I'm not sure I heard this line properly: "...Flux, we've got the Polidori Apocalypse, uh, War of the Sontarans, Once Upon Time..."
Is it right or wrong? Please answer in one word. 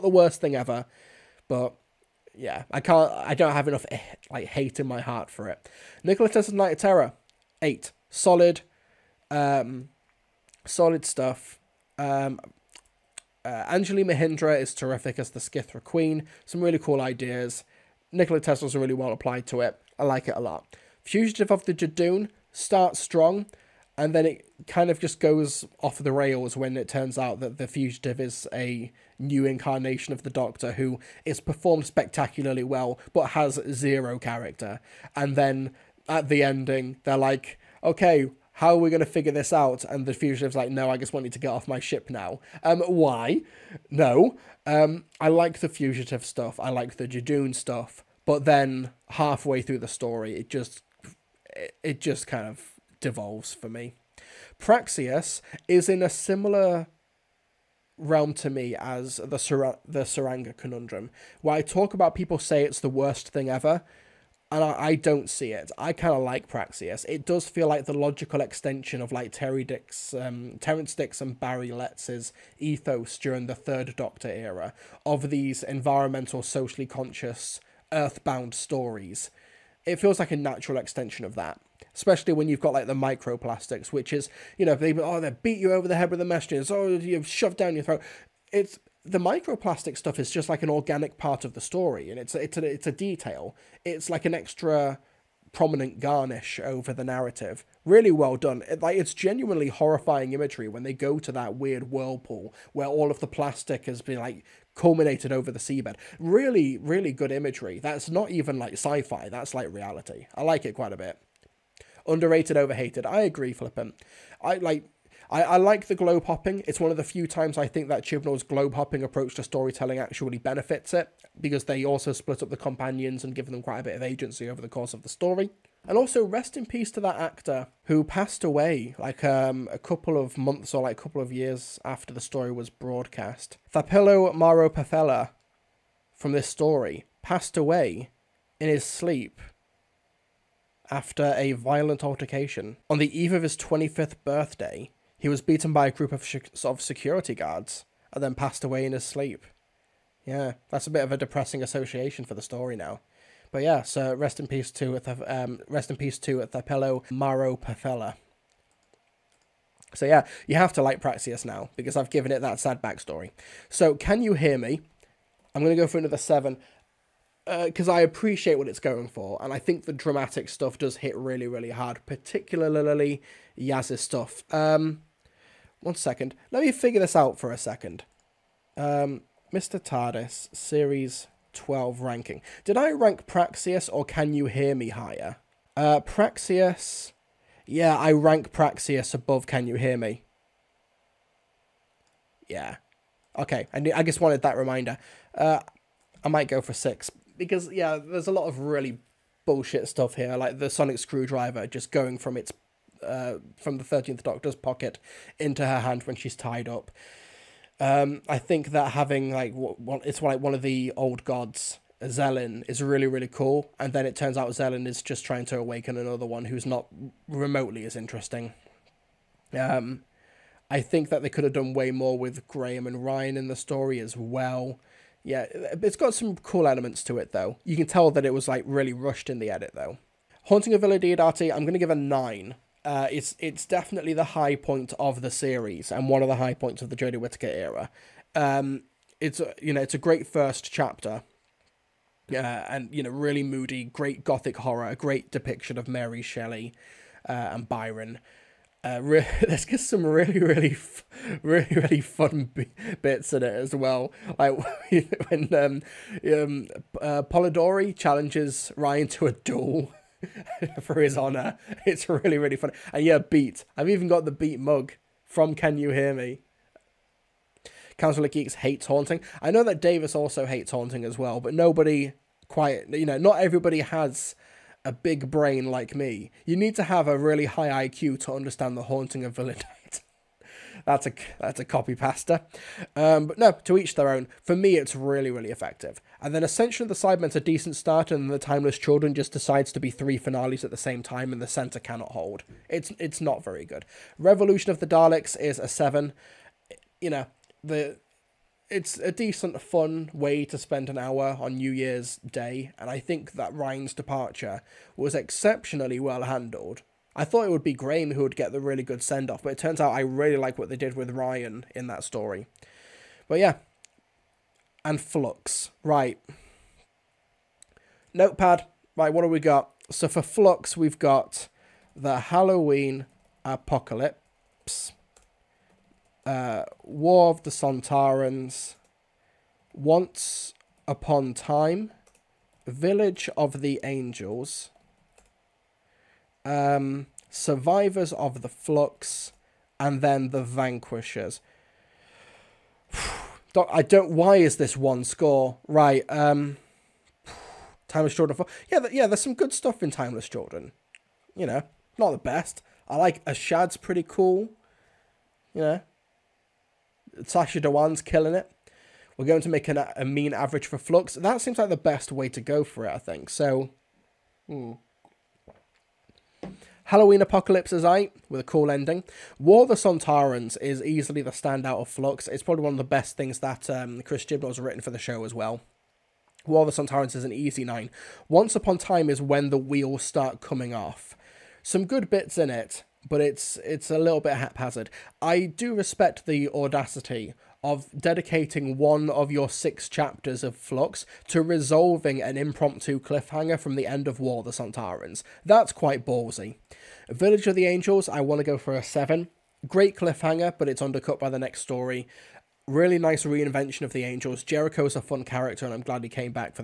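wrong.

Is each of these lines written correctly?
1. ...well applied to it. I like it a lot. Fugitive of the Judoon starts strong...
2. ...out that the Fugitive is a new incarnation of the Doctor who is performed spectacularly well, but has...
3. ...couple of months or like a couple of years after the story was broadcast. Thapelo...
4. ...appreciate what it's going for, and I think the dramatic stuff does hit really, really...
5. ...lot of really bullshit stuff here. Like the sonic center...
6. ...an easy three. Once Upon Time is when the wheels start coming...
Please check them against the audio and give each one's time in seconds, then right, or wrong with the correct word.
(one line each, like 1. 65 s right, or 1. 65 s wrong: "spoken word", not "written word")
1. 18 s right
2. 27 s right
3. 129 s right
4. 168 s right
5. 198 s wrong: "screwdriver", not "center"
6. 377 s wrong: "nine", not "three".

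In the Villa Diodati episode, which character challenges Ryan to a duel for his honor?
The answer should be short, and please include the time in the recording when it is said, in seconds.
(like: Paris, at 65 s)
Polidori, at 257 s.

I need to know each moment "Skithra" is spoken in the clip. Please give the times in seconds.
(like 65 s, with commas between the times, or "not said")
15 s.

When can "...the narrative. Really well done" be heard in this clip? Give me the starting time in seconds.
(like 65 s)
96 s.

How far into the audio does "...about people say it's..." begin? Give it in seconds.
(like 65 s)
61 s.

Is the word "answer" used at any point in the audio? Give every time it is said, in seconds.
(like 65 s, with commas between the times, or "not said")
not said.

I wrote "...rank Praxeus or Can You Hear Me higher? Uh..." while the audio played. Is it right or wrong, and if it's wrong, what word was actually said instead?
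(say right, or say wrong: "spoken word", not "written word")
right.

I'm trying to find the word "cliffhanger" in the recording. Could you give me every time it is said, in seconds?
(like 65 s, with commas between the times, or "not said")
392 s, 399 s.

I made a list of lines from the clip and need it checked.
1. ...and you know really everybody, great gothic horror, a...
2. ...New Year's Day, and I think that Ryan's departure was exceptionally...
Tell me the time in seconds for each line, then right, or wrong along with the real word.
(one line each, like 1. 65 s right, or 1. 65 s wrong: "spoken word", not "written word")
1. 242 s wrong: "moody", not "everybody"
2. 301 s right.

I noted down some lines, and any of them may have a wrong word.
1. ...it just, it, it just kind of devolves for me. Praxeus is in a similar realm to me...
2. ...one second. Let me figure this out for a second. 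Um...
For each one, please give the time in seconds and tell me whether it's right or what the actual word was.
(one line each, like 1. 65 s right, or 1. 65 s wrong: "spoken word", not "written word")
1. 50 s right
2. 175 s right.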